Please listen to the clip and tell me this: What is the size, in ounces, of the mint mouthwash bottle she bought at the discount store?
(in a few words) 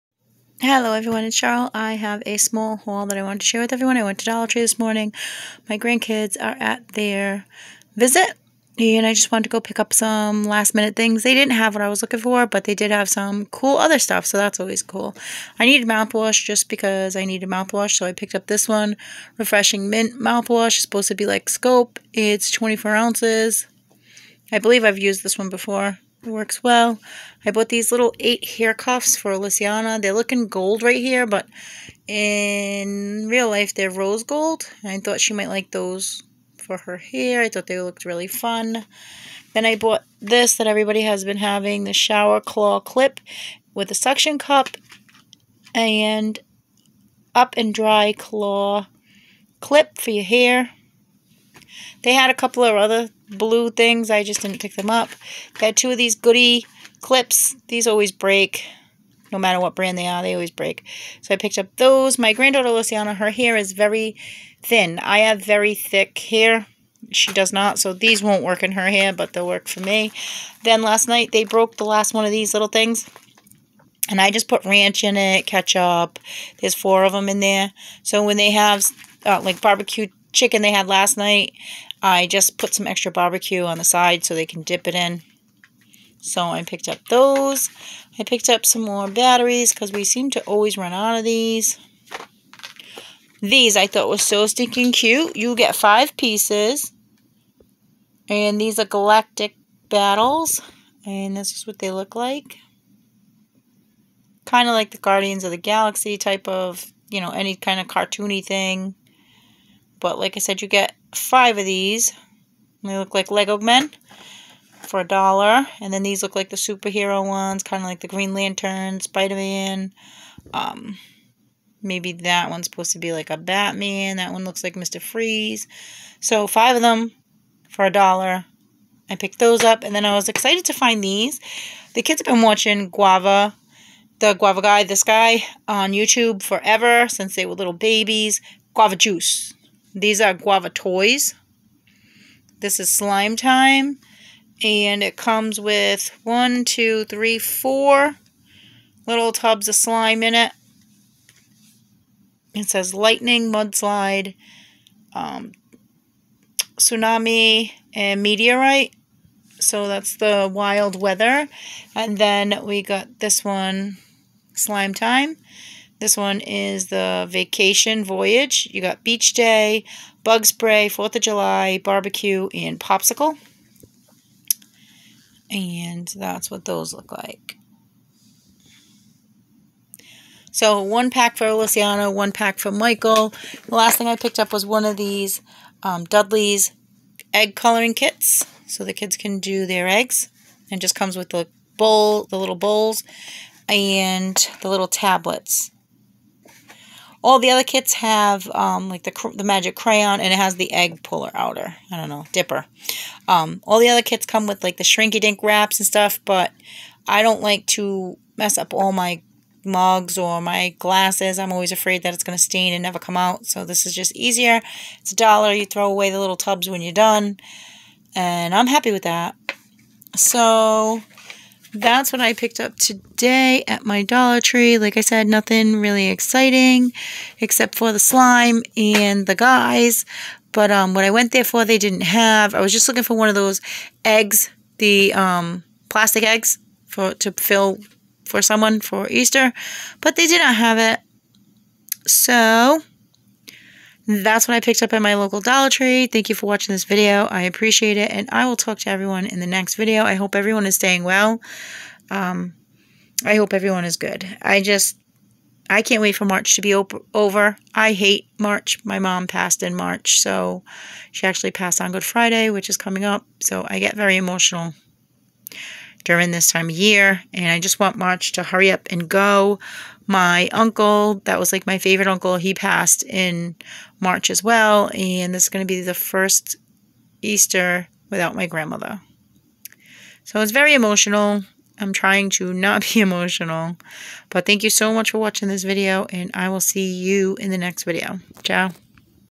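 24.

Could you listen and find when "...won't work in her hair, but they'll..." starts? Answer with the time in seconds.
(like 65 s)
68 s.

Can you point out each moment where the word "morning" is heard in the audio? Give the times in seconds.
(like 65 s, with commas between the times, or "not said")
4 s.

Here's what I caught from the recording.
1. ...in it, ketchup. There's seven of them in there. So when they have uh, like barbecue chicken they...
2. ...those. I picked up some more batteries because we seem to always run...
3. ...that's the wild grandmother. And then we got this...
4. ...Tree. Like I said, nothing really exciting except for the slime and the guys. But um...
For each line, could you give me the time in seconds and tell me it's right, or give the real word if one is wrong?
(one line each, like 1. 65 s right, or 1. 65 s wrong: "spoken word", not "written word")
1. 75 s wrong: "four", not "seven"
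2. 87 s right
3. 159 s wrong: "weather", not "grandmother"
4. 224 s right.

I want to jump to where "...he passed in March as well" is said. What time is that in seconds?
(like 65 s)
272 s.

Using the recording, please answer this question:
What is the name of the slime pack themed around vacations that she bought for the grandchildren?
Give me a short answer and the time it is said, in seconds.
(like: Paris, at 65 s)
Vacation Voyage, at 167 s.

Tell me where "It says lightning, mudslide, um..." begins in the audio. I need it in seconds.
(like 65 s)
152 s.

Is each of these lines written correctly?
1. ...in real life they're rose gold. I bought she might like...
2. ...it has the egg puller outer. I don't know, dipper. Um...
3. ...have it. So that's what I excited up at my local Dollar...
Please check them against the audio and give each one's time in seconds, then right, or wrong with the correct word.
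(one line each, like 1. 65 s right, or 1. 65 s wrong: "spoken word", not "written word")
1. 32 s wrong: "thought", not "bought"
2. 200 s right
3. 240 s wrong: "picked", not "excited".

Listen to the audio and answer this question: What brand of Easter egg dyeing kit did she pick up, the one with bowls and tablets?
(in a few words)
Dudley's.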